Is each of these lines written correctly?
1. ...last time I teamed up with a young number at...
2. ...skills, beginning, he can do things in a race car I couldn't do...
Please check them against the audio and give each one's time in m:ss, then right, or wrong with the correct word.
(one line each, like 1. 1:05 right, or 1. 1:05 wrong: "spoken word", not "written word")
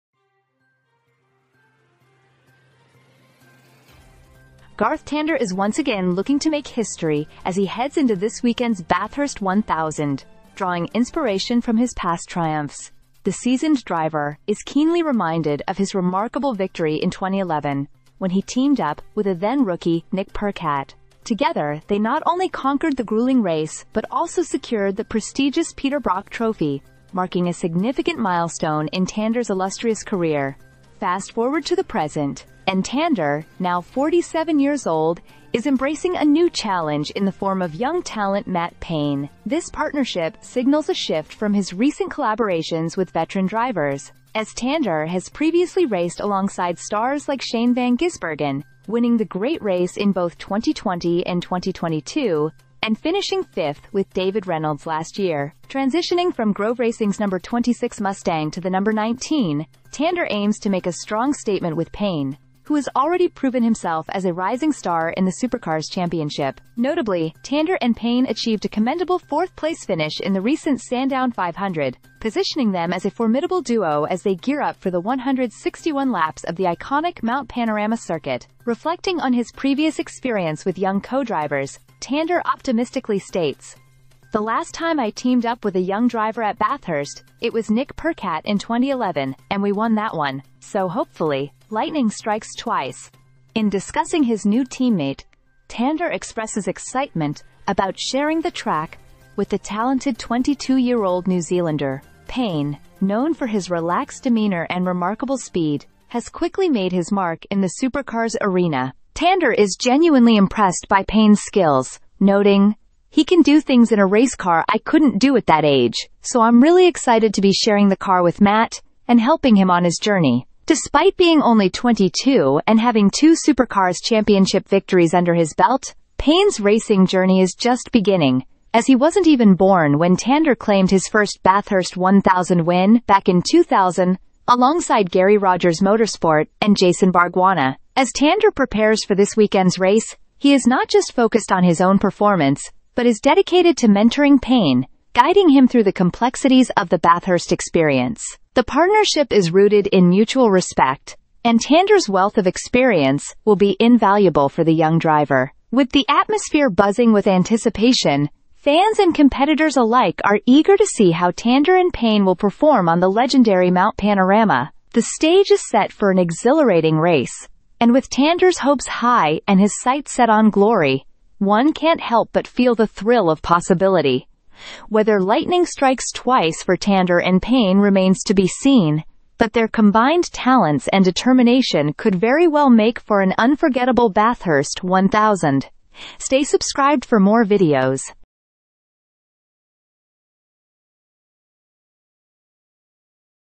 1. 1:24 wrong: "driver", not "number"
2. 1:51 wrong: "noting", not "beginning".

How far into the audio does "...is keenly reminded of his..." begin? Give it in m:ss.
0:14.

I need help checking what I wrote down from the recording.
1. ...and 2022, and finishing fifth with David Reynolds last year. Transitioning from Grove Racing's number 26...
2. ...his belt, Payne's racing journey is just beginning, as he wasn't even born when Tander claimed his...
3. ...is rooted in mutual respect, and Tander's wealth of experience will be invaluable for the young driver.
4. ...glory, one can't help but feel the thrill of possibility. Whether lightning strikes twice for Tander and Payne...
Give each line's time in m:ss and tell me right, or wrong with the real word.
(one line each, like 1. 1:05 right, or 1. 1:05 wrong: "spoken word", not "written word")
1. 0:51 right
2. 2:05 right
3. 2:29 right
4. 2:50 right.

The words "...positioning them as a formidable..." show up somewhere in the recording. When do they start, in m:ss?
1:12.